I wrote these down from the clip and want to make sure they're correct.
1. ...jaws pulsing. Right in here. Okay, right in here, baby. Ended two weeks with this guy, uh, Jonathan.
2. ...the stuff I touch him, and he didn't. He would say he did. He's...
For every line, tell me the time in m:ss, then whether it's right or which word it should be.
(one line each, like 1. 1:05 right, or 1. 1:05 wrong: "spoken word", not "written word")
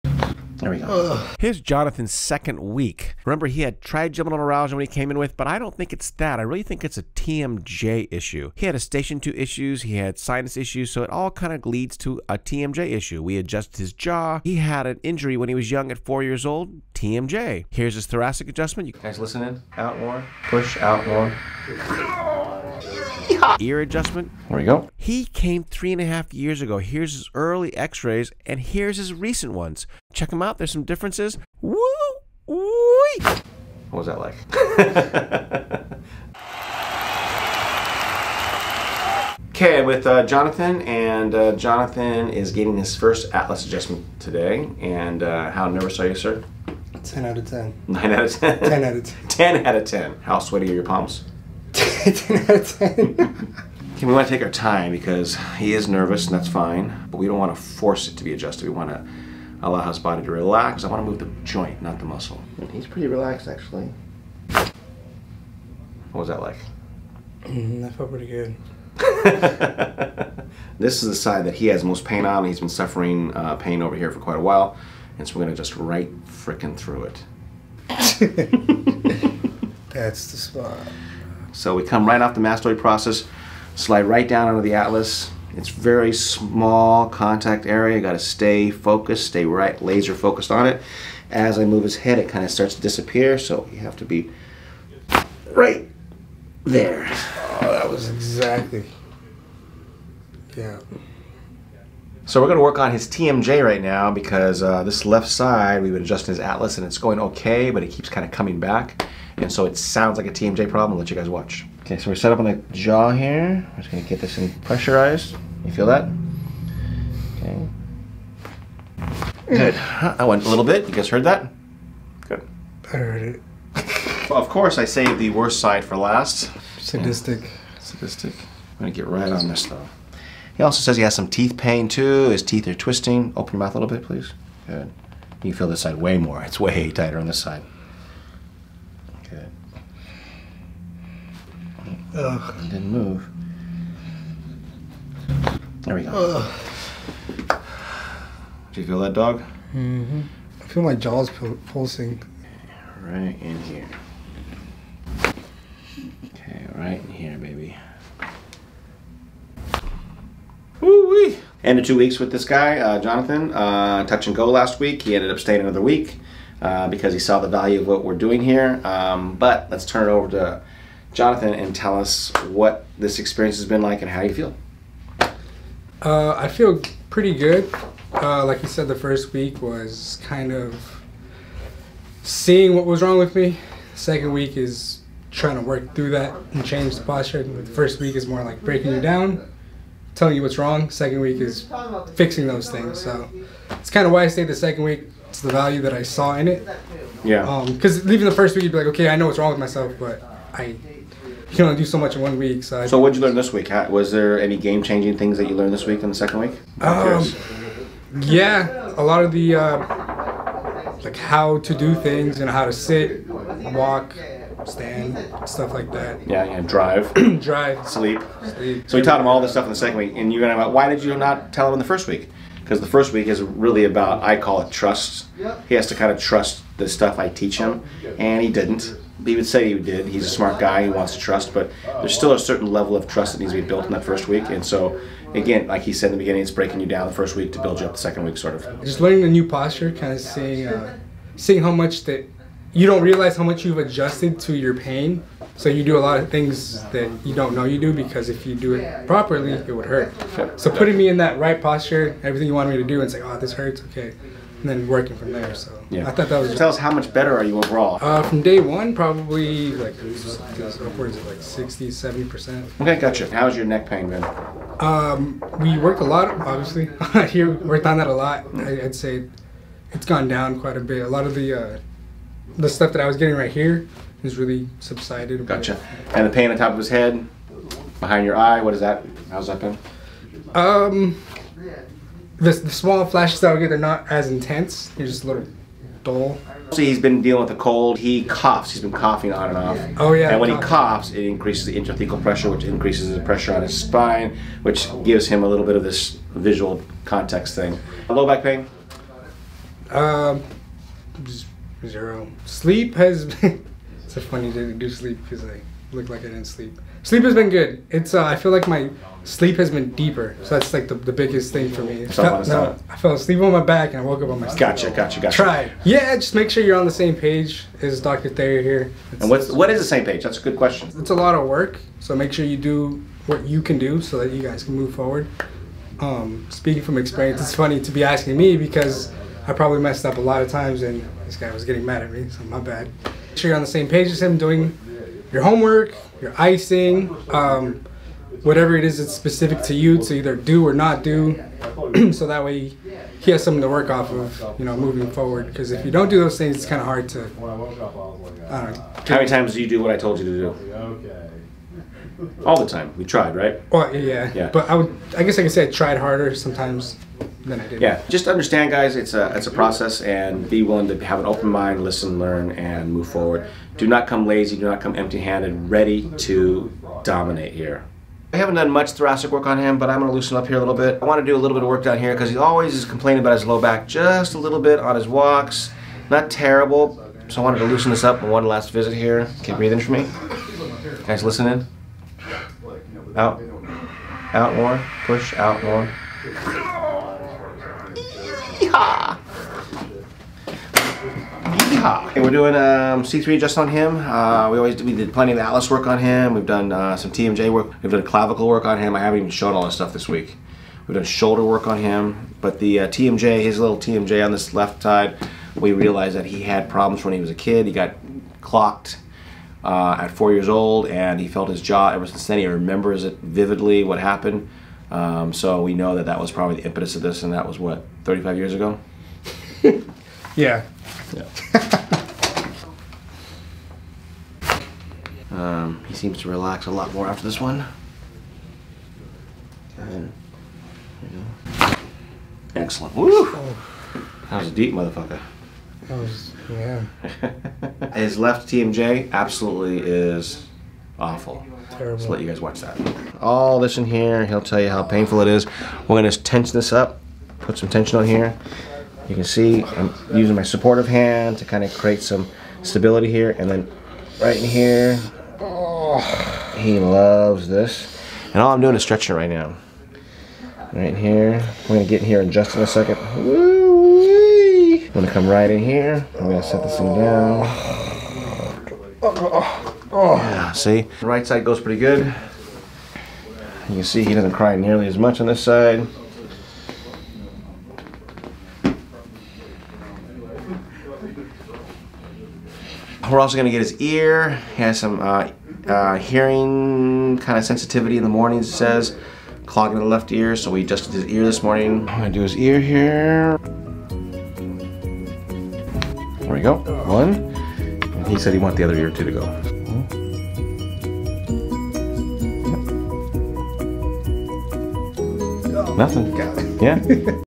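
1. 2:30 right
2. 3:46 wrong: "teach", not "touch".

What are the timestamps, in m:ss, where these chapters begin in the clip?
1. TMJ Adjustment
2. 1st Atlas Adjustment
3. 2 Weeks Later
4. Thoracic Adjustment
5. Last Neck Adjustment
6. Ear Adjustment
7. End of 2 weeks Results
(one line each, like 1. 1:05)
1. 1:56
2. 1:03
3. 0:39
4. 6:08
5. 7:03
6. 8:13
7. 4:16.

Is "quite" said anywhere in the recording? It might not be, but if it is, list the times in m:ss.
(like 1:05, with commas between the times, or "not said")
1:14, 4:30.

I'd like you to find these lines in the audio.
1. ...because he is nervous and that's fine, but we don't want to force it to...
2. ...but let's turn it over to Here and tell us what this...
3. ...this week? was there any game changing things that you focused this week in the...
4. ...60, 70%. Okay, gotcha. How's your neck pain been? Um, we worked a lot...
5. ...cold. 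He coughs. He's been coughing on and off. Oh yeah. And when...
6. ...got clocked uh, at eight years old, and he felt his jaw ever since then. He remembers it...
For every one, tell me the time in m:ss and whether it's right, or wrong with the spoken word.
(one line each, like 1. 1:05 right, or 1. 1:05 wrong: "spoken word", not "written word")
1. 0:54 right
2. 2:49 wrong: "Jonathan", not "Here"
3. 3:23 wrong: "learned", not "focused"
4. 4:21 right
5. 4:47 right
6. 6:47 wrong: "four", not "eight".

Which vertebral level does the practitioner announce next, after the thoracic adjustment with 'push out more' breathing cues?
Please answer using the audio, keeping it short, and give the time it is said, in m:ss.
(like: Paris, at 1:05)
C3, at 6:33.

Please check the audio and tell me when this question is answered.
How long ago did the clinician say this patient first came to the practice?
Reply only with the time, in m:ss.
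0:25.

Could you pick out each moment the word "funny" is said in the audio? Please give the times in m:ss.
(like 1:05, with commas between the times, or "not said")
5:04, 5:27.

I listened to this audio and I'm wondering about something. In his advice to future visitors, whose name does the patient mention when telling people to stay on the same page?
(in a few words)
Dr. Thayer.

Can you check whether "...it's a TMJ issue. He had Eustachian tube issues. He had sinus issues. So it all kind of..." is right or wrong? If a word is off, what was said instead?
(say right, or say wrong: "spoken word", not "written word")
right.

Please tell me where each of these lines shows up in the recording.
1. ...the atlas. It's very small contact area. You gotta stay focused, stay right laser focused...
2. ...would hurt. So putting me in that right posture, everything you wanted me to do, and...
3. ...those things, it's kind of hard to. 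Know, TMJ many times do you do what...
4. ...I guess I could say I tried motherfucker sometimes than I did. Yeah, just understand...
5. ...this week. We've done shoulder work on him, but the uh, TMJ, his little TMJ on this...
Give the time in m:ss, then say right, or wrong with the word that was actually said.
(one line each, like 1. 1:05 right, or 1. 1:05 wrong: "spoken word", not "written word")
1. 1:24 right
2. 4:09 right
3. 5:46 wrong: "How", not "TMJ"
4. 5:55 wrong: "harder", not "motherfucker"
5. 6:39 right.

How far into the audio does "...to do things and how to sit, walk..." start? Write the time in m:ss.
3:31.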